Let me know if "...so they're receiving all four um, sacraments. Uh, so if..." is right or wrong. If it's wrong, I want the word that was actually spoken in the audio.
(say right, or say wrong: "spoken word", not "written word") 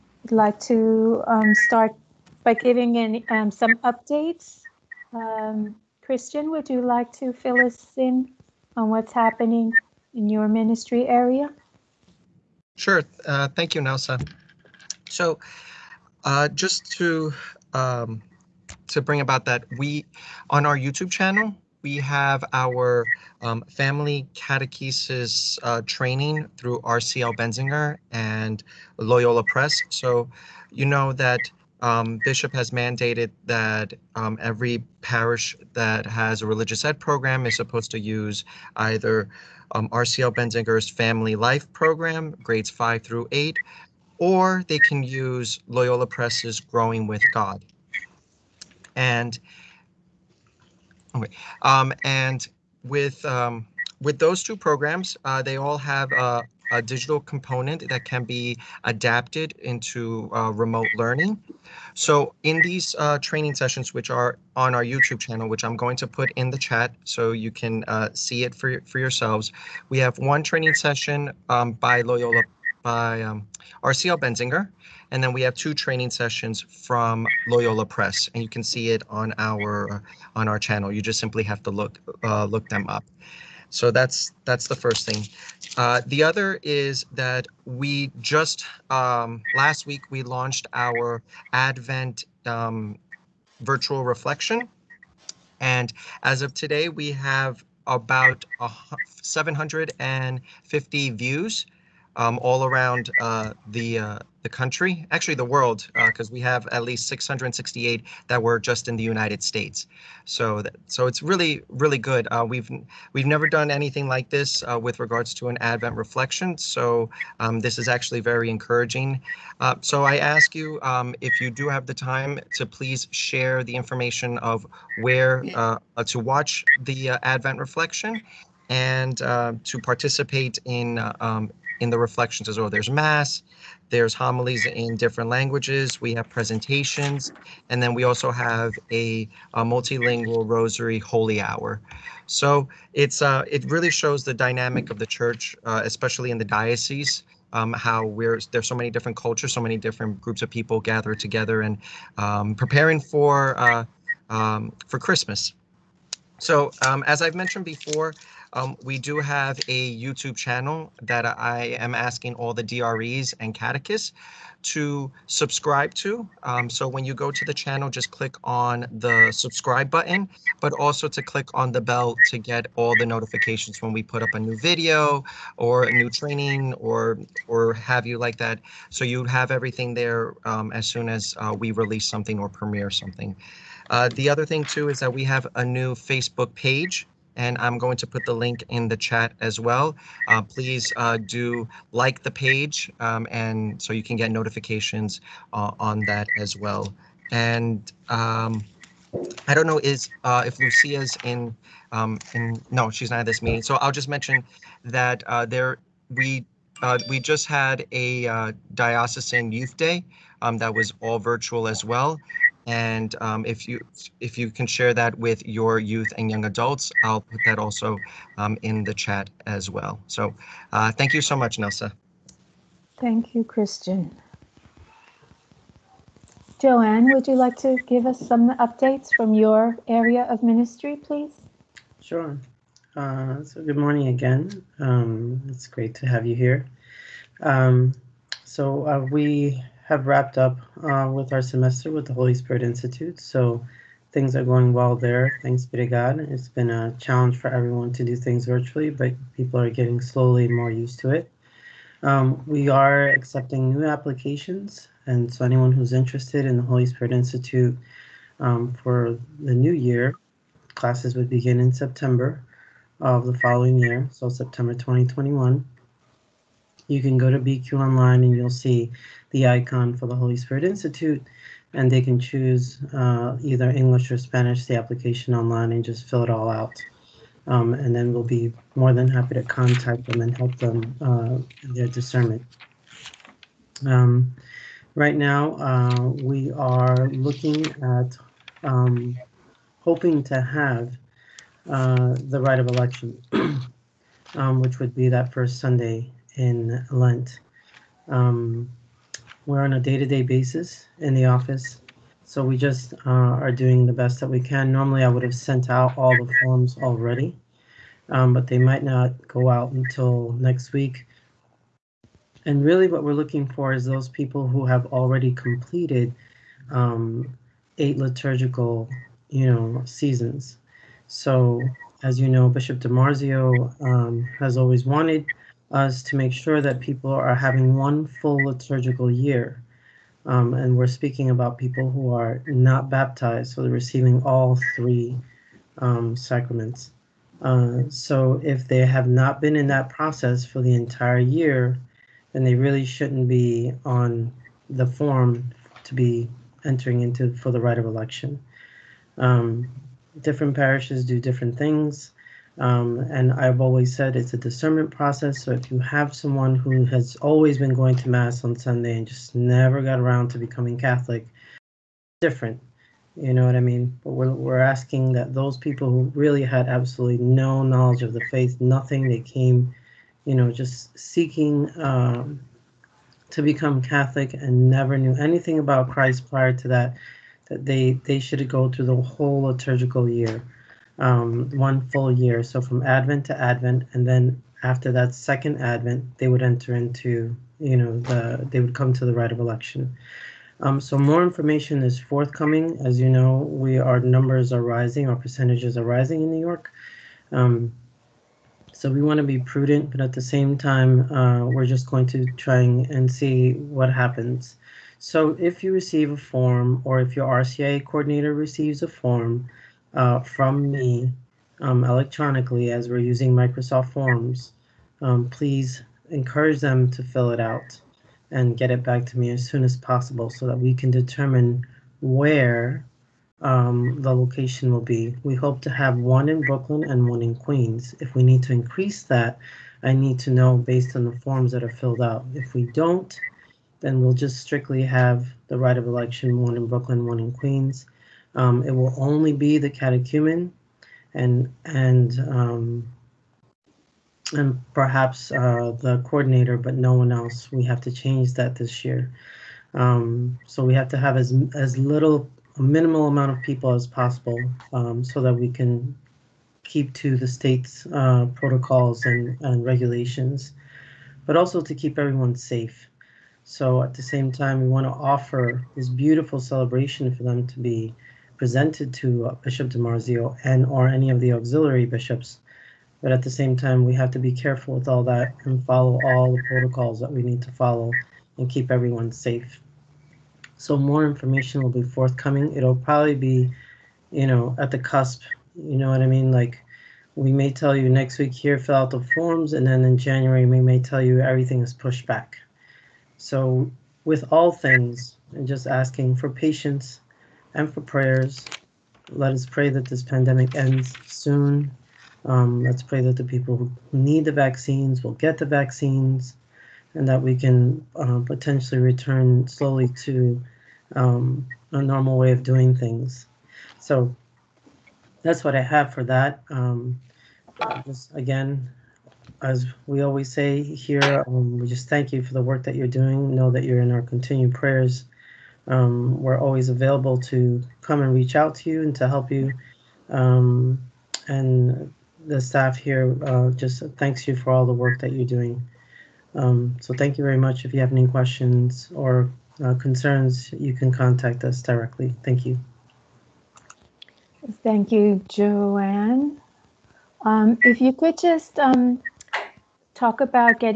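wrong: "three", not "four".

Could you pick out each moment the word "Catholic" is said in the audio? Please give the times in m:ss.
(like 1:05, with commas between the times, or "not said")
6:00, 6:13.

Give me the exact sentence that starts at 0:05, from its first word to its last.
Um, Christian, would you like to fill us in on what's happening in your ministry area?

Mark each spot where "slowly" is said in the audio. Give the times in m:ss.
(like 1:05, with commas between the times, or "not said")
4:09, 8:29.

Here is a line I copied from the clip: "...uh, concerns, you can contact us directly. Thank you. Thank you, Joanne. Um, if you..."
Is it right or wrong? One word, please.
right.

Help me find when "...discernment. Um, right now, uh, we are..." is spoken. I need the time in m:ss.
4:41.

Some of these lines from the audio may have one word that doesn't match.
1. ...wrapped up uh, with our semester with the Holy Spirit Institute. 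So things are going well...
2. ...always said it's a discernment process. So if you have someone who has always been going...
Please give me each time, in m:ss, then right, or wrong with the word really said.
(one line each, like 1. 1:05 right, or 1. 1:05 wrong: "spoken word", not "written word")
1. 4:00 right
2. 5:53 right.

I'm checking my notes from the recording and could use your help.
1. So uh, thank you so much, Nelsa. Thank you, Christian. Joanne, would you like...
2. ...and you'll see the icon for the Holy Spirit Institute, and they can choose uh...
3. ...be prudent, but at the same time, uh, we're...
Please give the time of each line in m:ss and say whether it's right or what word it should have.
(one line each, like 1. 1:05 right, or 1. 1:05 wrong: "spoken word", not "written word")
1. 3:40 right
2. 4:28 right
3. 6:39 right.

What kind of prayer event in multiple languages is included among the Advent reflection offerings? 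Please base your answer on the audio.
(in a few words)
rosary holy hour.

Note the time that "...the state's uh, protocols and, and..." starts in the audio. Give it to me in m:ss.
7:37.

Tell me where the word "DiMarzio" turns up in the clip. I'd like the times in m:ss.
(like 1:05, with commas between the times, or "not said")
5:22, 7:49.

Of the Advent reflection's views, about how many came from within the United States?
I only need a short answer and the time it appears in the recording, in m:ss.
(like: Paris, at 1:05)
668, at 1:47.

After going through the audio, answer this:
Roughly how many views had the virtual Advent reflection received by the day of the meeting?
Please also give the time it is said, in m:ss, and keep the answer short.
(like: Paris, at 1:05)
750, at 1:39.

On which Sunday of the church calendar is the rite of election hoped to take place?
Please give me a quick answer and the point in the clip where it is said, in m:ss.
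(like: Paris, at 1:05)
first Sunday in Lent, at 4:55.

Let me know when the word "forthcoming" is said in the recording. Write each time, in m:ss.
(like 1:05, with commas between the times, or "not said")
6:31, 8:01.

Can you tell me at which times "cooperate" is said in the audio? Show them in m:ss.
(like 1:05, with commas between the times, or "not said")
not said.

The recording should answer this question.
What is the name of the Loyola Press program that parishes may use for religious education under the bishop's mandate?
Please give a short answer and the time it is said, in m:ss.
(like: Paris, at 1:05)
Growing with God, at 0:46.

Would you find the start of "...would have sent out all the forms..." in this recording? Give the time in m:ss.
5:05.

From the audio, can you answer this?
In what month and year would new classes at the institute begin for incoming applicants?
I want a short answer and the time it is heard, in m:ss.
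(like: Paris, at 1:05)
September 2021, at 4:24.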